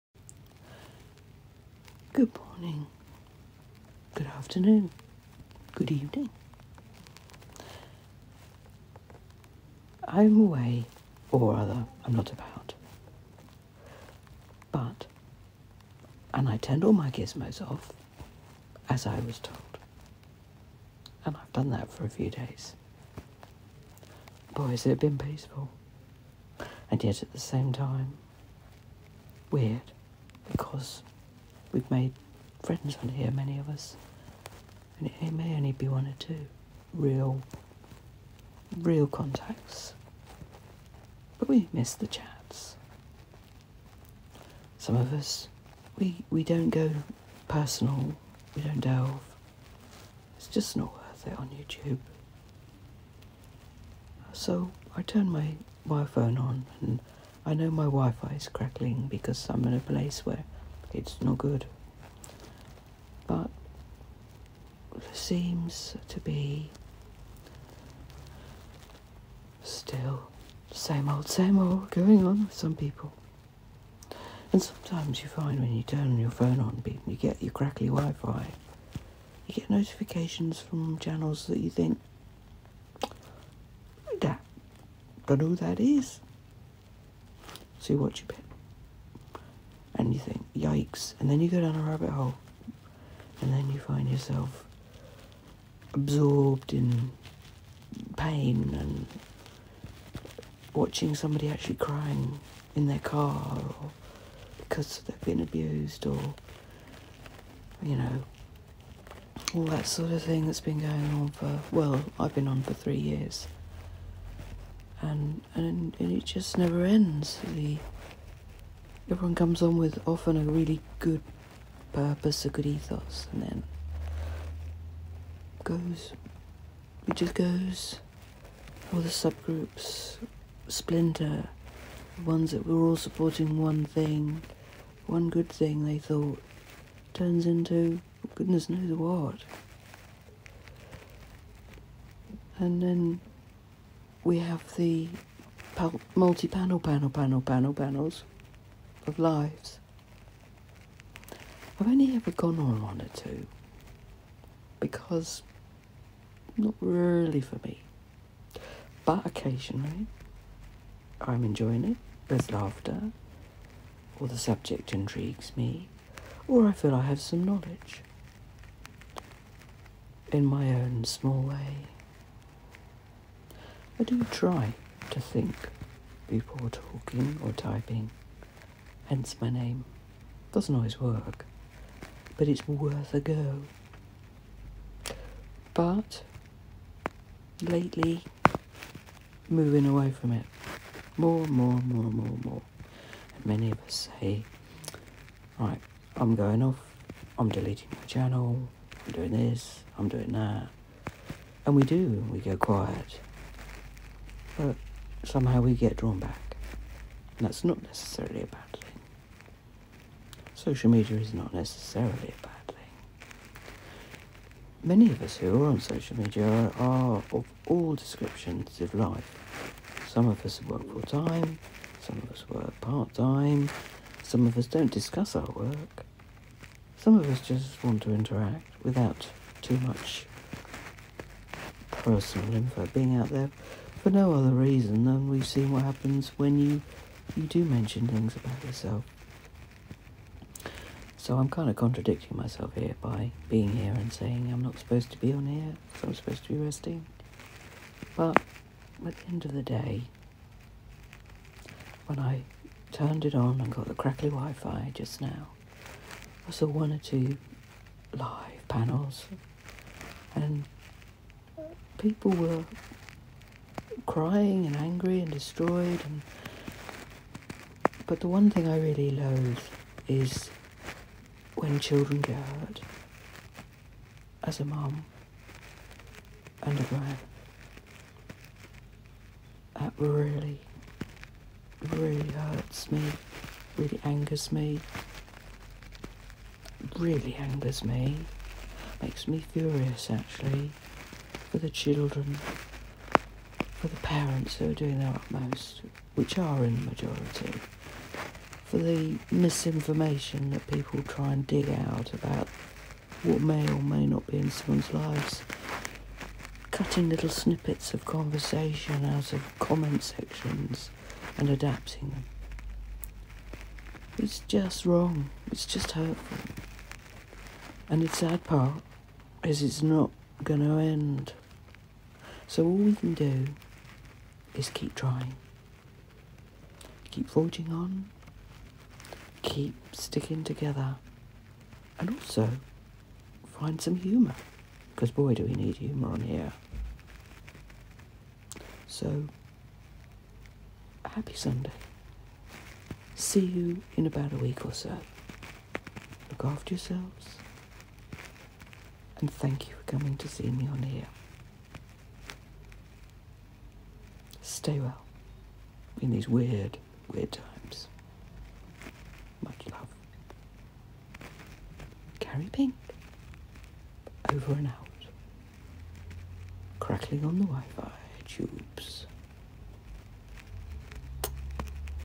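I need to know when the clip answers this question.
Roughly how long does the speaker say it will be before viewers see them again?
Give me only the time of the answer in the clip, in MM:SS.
05:44.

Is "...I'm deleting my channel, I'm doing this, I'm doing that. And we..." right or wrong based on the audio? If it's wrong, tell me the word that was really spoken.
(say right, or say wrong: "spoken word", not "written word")
right.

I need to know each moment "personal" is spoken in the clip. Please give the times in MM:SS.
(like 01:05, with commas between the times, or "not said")
00:47, 03:51.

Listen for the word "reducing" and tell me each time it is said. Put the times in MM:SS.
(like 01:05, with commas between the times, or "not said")
not said.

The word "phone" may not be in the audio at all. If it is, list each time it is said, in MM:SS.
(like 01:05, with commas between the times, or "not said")
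00:56, 01:16.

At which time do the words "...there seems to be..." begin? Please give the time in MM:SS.
01:04.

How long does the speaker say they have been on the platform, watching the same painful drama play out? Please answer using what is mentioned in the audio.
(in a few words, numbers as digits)
3 years.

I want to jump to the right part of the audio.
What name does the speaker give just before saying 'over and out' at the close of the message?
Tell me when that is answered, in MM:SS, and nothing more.
06:02.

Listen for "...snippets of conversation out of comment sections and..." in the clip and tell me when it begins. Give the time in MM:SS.
05:07.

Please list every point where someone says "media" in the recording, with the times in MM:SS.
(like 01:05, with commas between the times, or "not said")
03:30, 03:36.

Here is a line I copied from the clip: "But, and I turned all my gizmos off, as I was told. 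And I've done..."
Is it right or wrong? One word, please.
right.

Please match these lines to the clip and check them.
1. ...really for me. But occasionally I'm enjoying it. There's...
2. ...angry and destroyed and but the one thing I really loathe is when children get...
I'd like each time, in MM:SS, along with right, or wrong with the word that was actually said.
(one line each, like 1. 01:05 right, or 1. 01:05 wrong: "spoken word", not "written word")
1. 02:36 right
2. 04:24 right.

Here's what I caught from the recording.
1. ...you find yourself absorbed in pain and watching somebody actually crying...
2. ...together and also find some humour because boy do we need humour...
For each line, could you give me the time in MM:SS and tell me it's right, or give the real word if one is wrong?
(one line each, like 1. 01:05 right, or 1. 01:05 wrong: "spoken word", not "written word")
1. 01:33 right
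2. 05:30 right.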